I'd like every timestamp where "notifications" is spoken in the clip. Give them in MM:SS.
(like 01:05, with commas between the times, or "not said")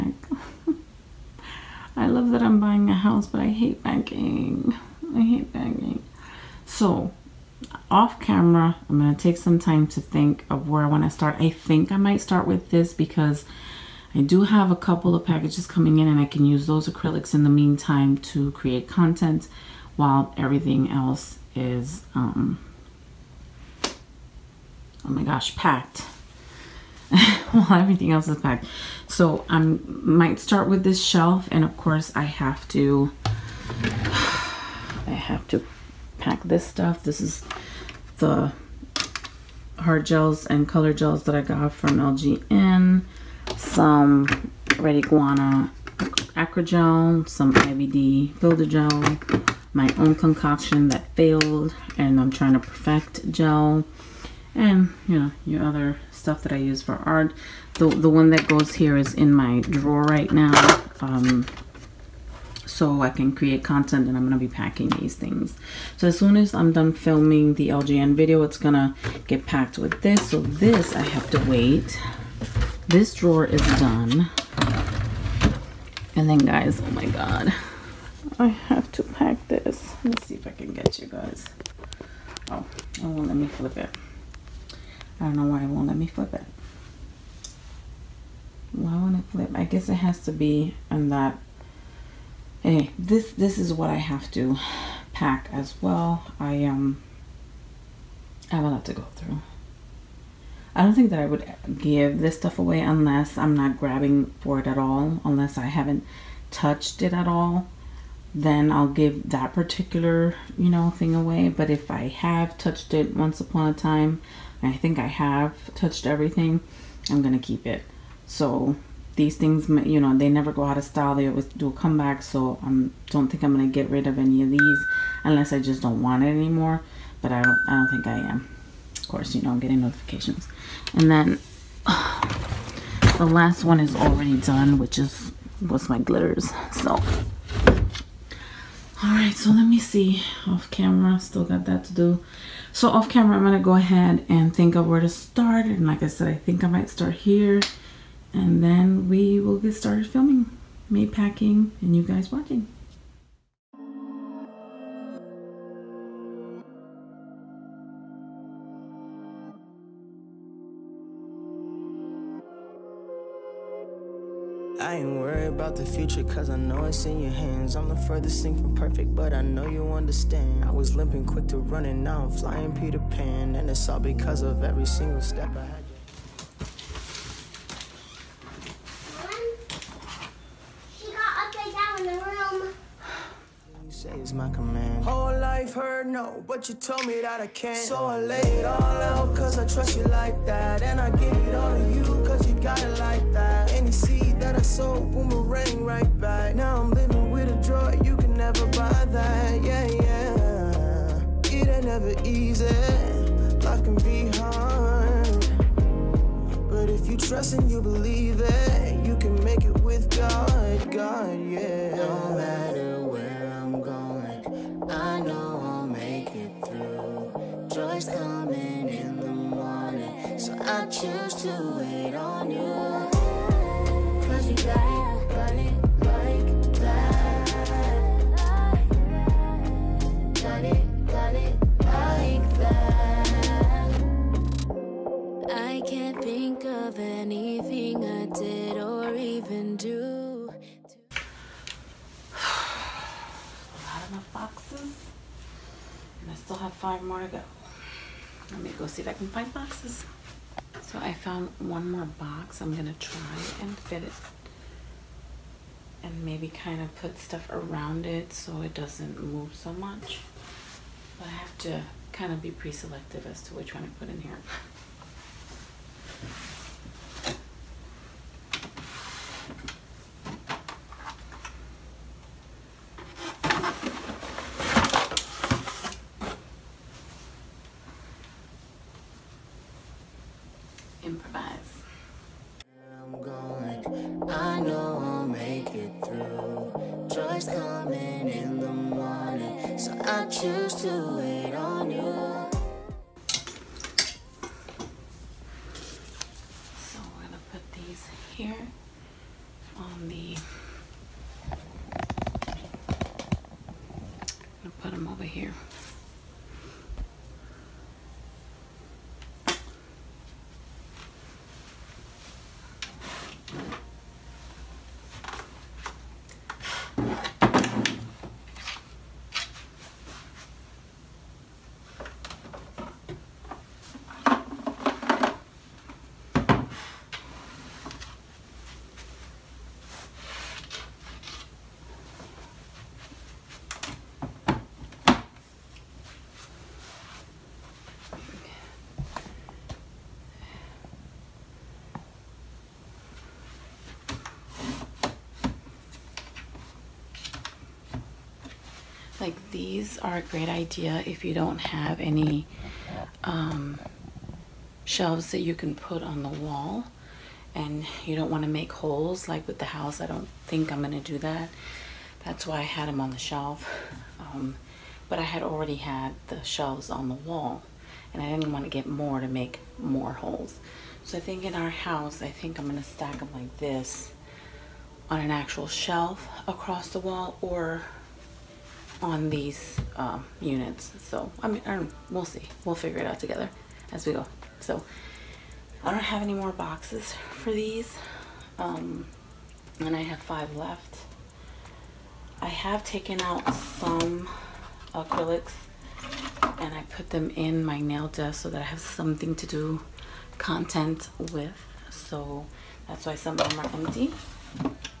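02:09.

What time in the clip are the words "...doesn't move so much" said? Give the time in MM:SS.
04:18.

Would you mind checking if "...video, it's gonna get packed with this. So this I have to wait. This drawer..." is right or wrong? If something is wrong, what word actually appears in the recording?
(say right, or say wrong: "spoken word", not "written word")
right.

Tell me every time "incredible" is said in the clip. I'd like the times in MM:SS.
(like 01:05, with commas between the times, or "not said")
not said.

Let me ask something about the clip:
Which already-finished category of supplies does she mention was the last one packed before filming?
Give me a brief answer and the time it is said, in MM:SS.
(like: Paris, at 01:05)
glitters, at 02:15.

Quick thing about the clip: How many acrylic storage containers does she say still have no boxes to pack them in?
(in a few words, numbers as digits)
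5.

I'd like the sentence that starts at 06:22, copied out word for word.
We'll figure it out together as we go.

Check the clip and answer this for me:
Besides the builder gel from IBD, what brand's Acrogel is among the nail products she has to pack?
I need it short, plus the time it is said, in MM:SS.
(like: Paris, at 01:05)
Red Iguana, at 00:44.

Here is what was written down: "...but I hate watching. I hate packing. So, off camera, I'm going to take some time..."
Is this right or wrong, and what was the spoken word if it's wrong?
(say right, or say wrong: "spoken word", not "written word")
wrong: "packing", not "watching".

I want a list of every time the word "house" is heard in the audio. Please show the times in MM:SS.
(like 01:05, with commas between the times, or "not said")
00:02, 05:59, 06:11.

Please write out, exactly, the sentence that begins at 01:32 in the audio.
Anyway, this this is what I have to pack as well.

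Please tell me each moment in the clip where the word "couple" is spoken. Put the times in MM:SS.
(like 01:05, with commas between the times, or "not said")
00:14.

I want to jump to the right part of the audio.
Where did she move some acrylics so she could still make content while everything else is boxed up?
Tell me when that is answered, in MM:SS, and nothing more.
06:37.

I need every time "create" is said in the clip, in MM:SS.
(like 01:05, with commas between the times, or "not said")
00:18, 01:03.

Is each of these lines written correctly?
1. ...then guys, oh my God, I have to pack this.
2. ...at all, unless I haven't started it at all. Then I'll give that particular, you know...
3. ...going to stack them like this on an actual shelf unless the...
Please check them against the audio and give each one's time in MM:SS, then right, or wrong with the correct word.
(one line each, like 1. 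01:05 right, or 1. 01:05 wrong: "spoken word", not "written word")
1. 01:16 right
2. 01:44 wrong: "touched", not "started"
3. 06:12 wrong: "across", not "unless".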